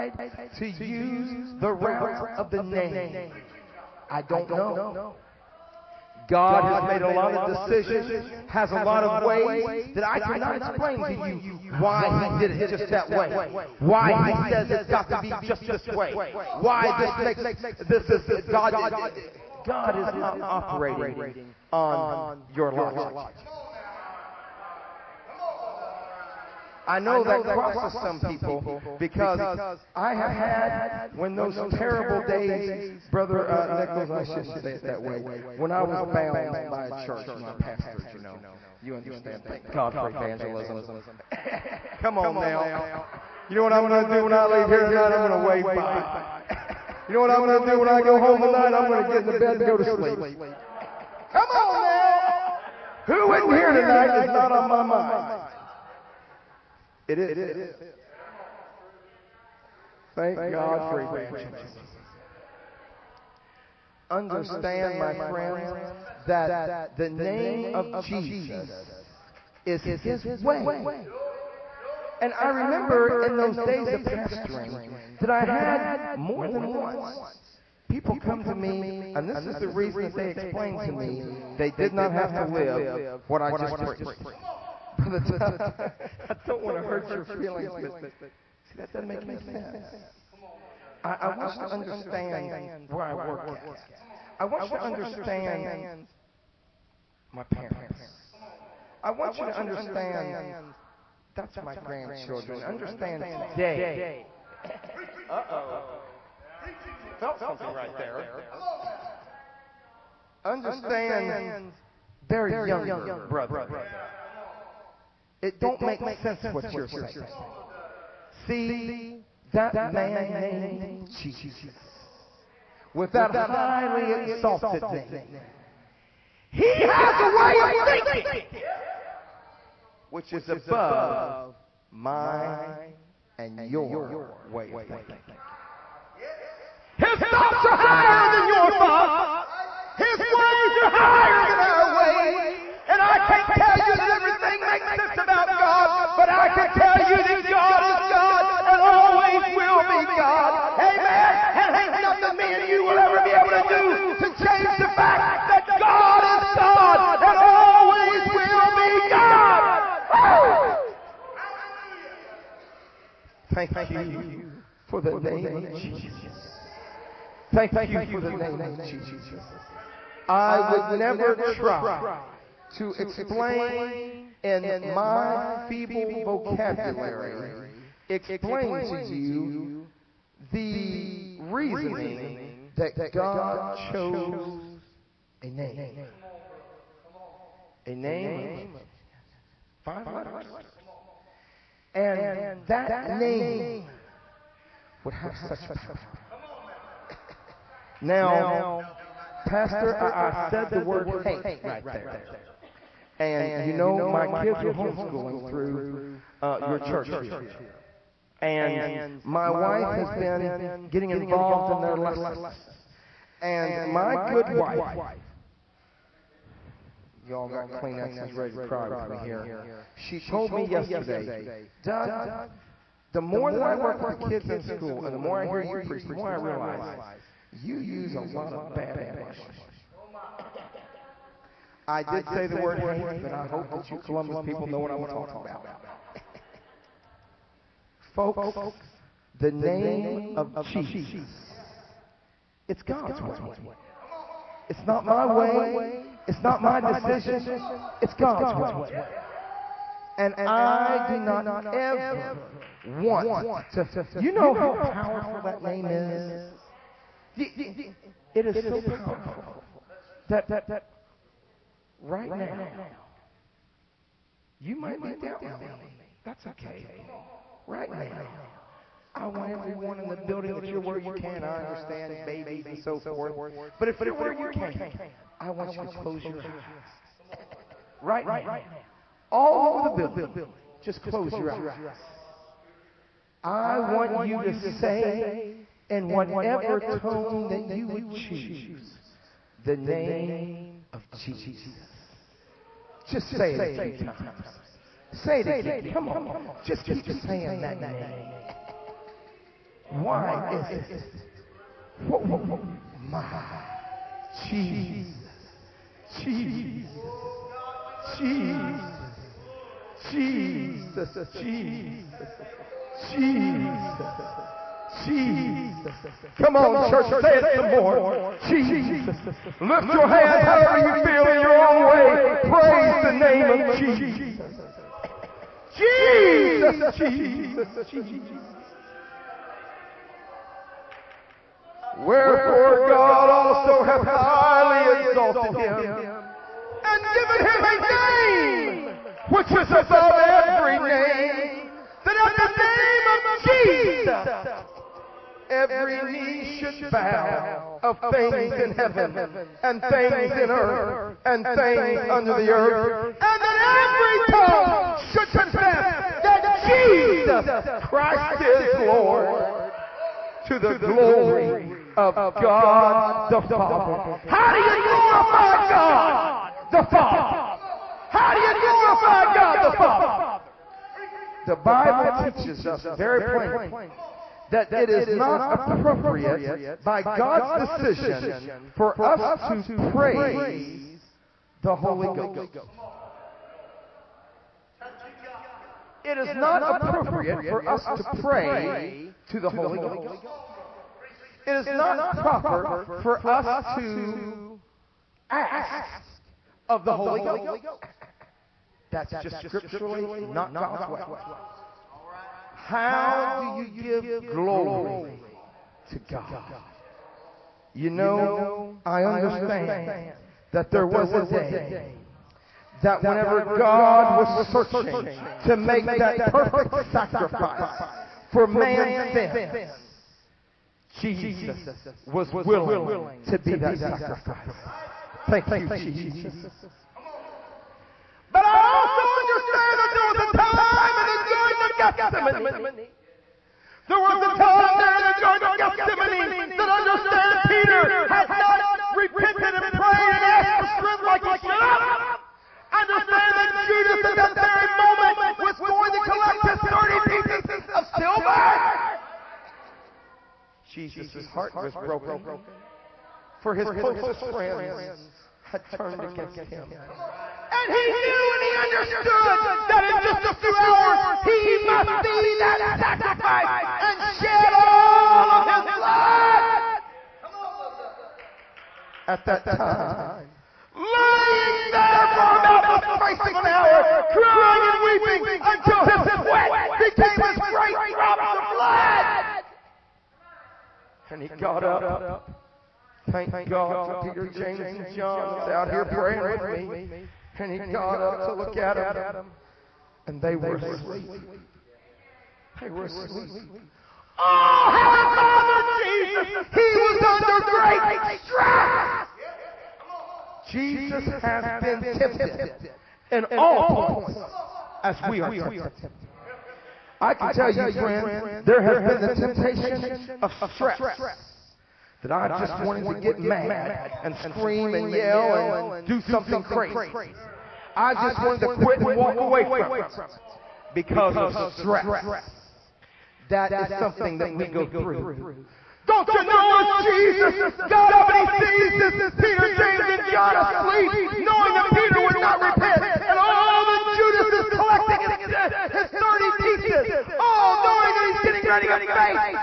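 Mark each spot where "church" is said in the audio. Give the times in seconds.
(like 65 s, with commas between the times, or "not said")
37 s, 206 s, 316 s.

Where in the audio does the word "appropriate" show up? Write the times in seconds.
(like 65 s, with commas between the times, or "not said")
375 s, 386 s.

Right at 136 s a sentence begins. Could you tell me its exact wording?
His thoughts are higher than your thoughts.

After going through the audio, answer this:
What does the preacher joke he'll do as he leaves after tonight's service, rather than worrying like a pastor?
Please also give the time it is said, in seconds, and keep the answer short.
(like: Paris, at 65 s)
Wave bye, at 45 s.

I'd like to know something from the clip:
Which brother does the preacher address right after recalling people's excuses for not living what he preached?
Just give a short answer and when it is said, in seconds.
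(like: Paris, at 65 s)
Brother Tuck, at 84 s.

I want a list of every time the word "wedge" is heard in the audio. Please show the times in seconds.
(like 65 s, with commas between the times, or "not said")
not said.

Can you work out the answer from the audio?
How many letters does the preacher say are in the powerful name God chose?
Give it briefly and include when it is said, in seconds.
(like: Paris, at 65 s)
5, at 189 s.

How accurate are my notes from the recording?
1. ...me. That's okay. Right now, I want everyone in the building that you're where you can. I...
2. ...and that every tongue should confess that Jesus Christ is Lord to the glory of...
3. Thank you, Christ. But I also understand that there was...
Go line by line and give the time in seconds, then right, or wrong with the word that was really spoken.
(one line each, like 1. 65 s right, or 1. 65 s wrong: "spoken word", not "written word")
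1. 265 s right
2. 353 s right
3. 425 s wrong: "Jesus", not "Christ".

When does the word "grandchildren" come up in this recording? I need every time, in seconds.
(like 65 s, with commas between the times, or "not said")
101 s.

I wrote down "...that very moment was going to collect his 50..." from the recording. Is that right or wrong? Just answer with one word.
wrong.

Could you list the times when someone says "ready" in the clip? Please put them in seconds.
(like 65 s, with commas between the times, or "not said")
218 s, 538 s.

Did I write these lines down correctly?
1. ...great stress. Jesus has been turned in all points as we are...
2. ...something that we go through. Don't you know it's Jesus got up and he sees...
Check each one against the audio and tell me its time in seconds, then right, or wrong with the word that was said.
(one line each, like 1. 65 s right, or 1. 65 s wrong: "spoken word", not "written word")
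1. 497 s wrong: "tempted", not "turned"
2. 523 s right.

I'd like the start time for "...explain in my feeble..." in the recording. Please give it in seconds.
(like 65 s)
172 s.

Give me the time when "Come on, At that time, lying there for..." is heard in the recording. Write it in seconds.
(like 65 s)
467 s.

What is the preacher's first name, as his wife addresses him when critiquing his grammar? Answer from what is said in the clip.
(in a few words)
Doug.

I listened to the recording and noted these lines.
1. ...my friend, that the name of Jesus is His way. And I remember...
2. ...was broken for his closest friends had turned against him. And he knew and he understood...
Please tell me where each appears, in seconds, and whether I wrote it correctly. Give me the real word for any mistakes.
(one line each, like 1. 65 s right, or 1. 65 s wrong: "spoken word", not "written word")
1. 64 s right
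2. 451 s right.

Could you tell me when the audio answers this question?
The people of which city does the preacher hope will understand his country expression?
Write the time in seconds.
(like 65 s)
233 s.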